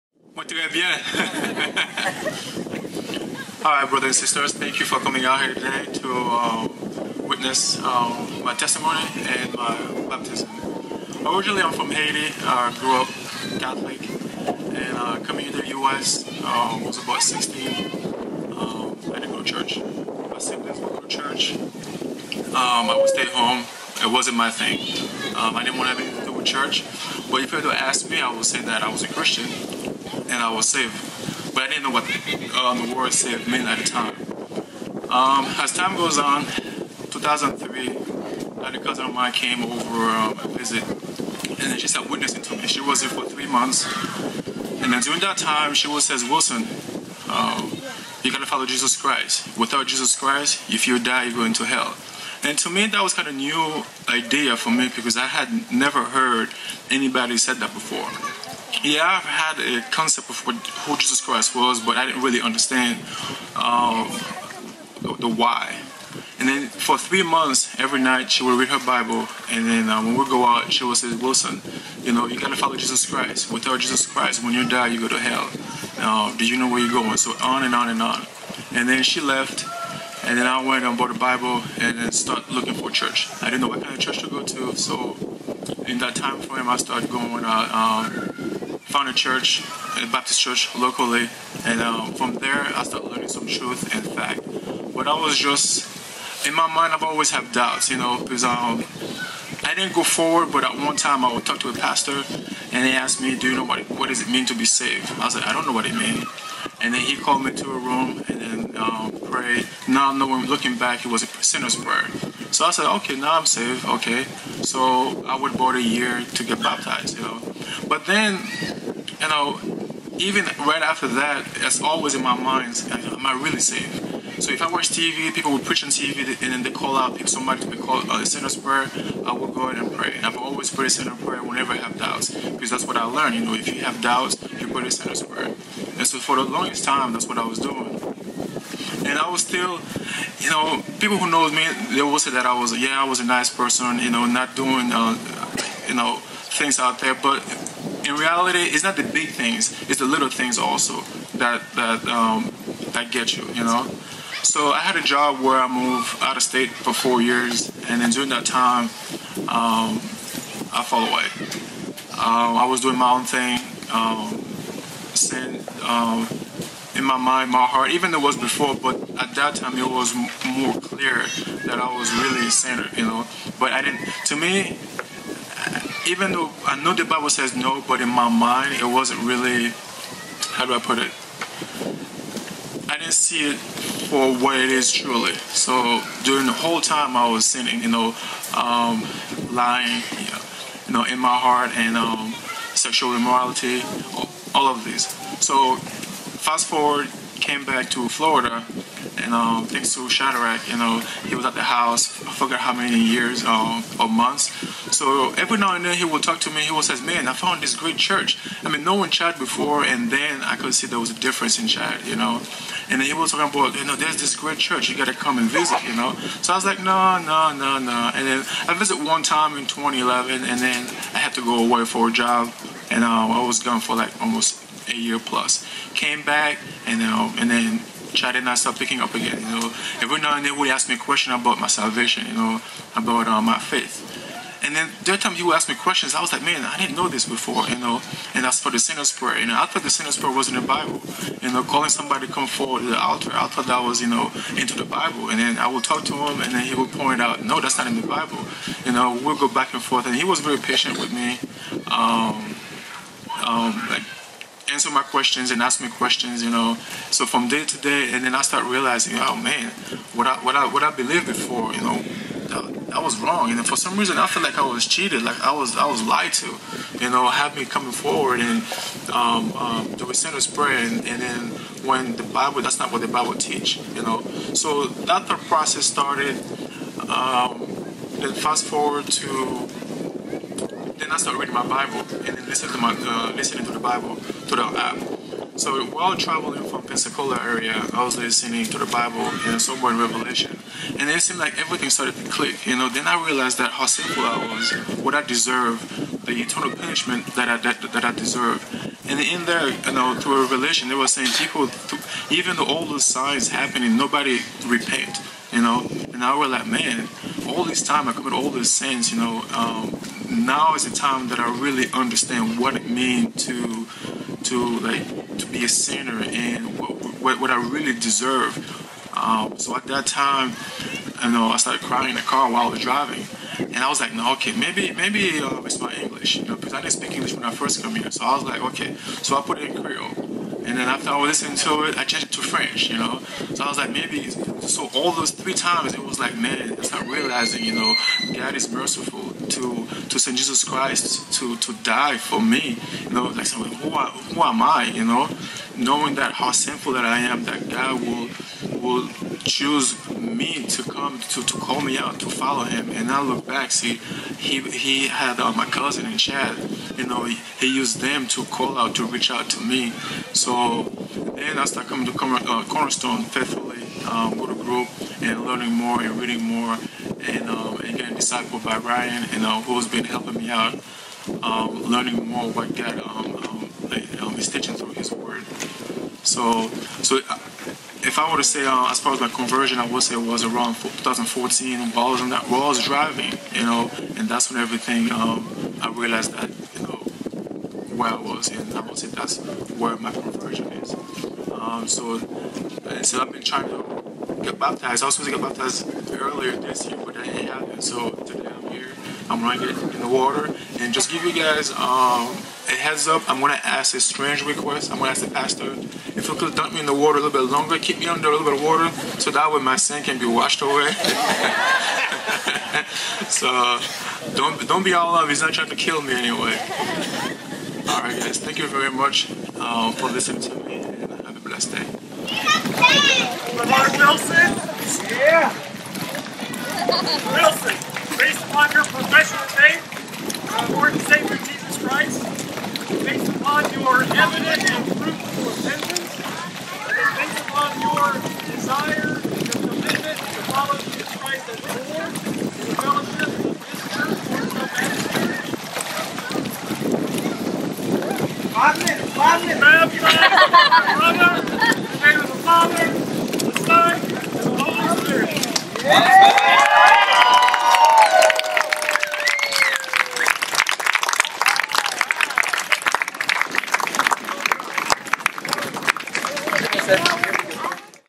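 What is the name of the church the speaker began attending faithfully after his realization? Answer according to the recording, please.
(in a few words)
Cornerstone.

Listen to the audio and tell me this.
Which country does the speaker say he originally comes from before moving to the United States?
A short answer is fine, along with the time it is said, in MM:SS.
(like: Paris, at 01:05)
Haiti, at 00:11.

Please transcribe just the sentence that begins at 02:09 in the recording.
I would go ahead and pray, and I've always prayed a sinner's prayer whenever I have doubts, because that's what I learned.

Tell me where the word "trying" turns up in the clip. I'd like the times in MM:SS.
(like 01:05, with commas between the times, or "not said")
06:33, 06:55.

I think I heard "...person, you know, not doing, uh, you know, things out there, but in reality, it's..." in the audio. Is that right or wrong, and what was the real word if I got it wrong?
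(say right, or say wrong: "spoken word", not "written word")
right.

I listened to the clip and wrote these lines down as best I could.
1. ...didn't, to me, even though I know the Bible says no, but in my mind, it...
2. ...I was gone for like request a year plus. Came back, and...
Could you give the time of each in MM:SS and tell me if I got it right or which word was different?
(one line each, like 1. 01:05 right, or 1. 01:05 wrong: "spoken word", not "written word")
1. 02:53 right
2. 03:43 wrong: "almost", not "request".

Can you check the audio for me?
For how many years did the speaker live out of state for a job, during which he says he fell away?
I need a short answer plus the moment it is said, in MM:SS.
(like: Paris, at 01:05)
4, at 02:36.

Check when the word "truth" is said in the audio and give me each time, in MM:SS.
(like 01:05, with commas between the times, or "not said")
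01:33.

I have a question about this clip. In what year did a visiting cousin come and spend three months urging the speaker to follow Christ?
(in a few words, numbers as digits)
2003.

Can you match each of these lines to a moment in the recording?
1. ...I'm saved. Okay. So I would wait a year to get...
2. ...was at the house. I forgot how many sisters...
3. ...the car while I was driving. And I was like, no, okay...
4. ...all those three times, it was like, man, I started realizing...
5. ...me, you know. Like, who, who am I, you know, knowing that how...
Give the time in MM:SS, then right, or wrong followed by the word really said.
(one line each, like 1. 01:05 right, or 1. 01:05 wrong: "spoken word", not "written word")
1. 01:53 right
2. 03:21 wrong: "years", not "sisters"
3. 05:22 right
4. 05:34 right
5. 05:42 right.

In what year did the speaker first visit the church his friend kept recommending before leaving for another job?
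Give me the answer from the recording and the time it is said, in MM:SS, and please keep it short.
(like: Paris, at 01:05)
2011, at 03:39.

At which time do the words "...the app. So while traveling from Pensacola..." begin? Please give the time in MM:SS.
04:44.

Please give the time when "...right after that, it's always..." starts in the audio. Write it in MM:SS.
02:00.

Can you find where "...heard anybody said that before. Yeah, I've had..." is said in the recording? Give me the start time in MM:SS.
00:56.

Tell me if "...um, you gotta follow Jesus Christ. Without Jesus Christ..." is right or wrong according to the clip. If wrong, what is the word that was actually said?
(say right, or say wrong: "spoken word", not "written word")
right.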